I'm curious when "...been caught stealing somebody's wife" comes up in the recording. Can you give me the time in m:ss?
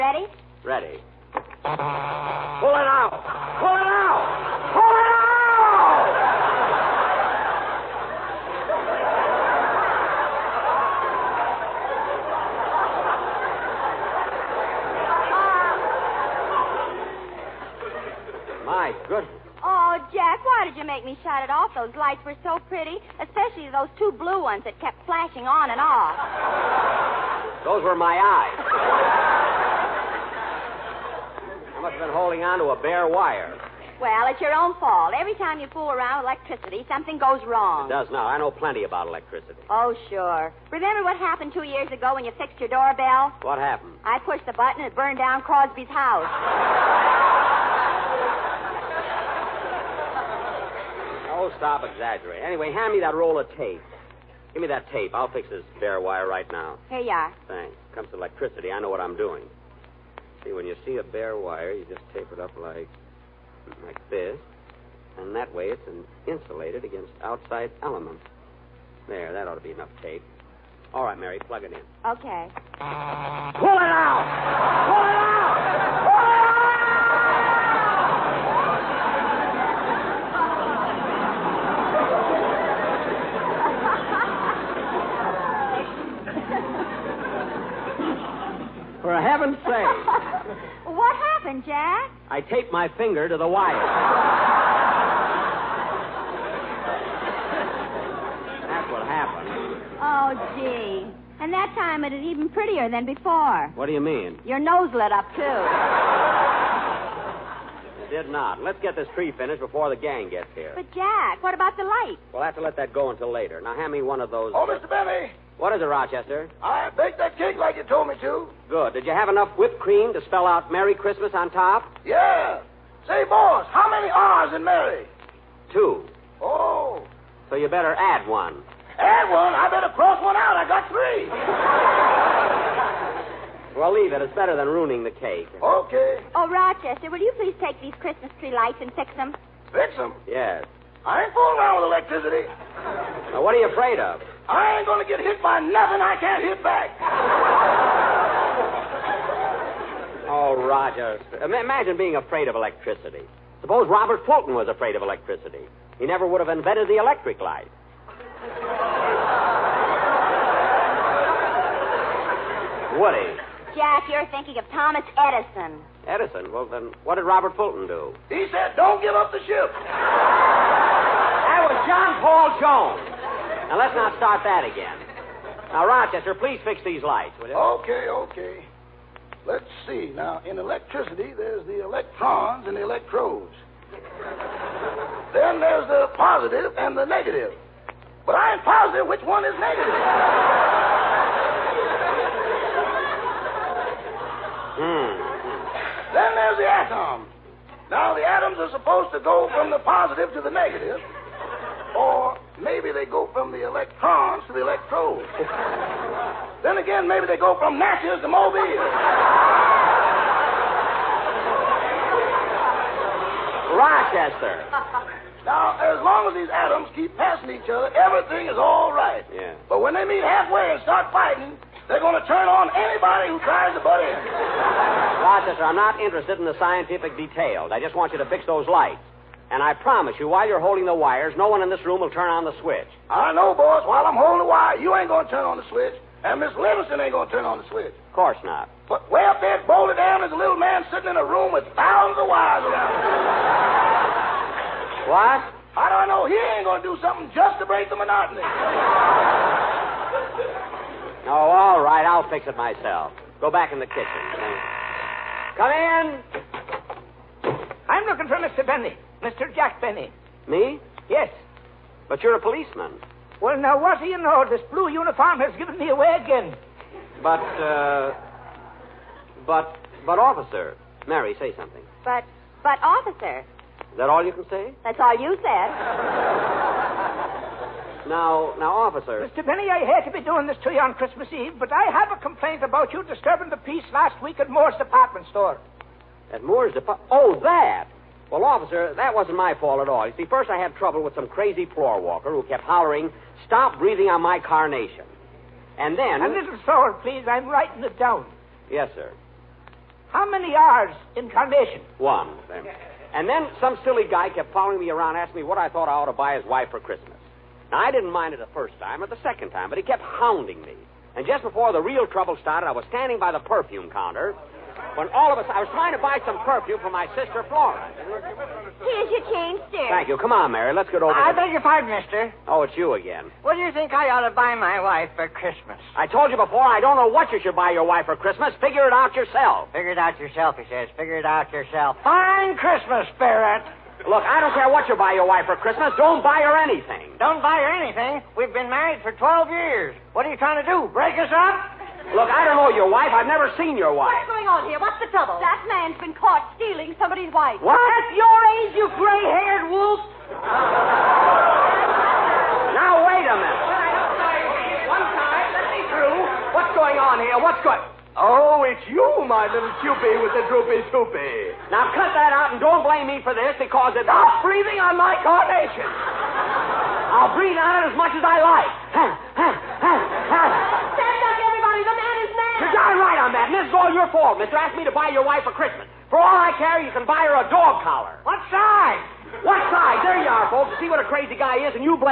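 5:46.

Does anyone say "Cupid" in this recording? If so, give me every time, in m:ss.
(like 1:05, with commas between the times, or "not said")
5:59.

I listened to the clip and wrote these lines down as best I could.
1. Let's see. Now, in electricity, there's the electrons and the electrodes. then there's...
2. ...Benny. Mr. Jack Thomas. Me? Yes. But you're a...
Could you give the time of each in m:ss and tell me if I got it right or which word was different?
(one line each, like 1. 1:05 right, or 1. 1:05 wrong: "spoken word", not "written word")
1. 2:59 right
2. 4:18 wrong: "Benny", not "Thomas".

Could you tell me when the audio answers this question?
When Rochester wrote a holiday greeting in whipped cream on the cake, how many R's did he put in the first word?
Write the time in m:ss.
2:13.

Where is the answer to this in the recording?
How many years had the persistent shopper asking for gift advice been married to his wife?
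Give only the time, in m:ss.
5:39.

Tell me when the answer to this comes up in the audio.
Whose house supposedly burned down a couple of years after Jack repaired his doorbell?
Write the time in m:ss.
0:45.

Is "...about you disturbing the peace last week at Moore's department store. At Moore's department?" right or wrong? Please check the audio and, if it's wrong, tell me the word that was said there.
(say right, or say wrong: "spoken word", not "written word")
right.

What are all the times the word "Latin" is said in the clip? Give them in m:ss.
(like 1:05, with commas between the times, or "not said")
not said.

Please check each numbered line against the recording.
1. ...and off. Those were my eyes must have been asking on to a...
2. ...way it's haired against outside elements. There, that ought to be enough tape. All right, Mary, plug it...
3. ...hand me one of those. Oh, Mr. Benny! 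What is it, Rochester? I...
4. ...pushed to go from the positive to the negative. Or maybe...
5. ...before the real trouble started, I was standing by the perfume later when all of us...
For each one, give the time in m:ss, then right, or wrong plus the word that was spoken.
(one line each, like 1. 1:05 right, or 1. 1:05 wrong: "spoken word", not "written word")
1. 0:25 wrong: "holding", not "asking"
2. 1:05 wrong: "insulated", not "haired"
3. 1:53 right
4. 3:18 wrong: "supposed", not "pushed"
5. 5:11 wrong: "counter", not "later".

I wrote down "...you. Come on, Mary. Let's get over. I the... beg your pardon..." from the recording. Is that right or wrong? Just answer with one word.
right.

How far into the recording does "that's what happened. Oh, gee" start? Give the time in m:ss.
1:38.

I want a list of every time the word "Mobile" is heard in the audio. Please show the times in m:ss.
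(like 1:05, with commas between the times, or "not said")
3:28.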